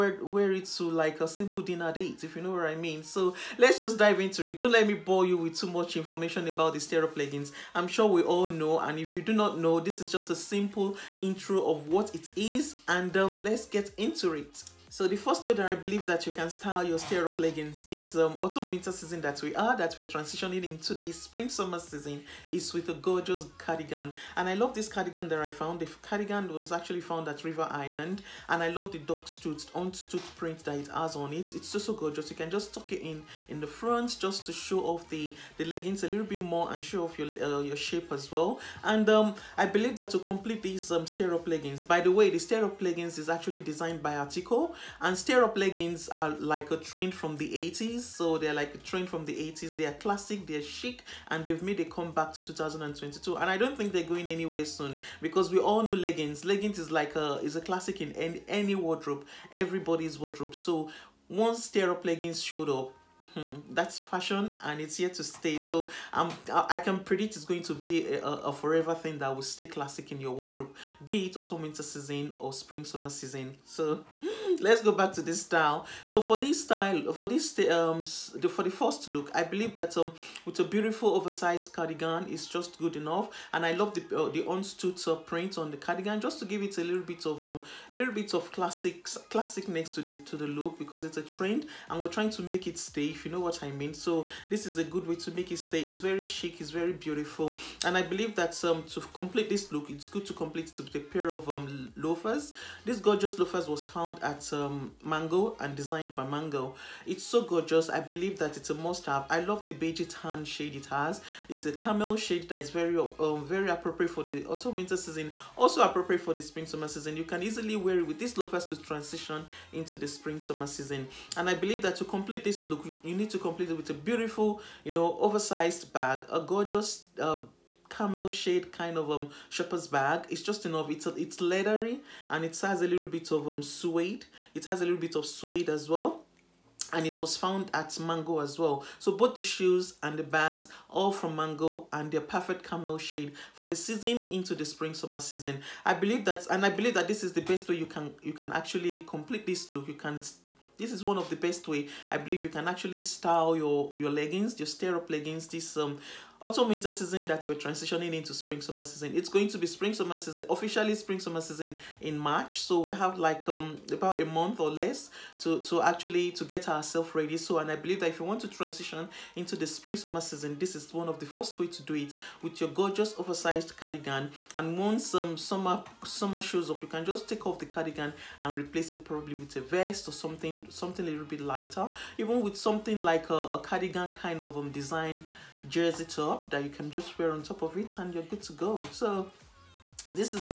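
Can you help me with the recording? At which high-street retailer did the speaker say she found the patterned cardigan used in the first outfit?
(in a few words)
River Island.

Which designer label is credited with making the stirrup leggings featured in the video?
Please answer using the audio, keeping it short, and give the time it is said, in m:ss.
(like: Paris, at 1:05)
Attico, at 0:44.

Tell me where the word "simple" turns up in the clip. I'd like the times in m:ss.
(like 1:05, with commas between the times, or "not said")
0:01, 0:10.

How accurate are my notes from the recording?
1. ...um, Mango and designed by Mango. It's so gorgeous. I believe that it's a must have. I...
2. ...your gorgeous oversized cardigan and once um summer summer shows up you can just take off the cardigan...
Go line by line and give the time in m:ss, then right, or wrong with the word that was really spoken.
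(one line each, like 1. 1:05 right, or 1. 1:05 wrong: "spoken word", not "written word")
1. 1:44 right
2. 2:52 right.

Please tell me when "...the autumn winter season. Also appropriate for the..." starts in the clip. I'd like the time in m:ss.
1:54.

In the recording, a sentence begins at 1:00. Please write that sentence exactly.
So once stirrup leggings showed up hmm, that's fashion and it's here to stay.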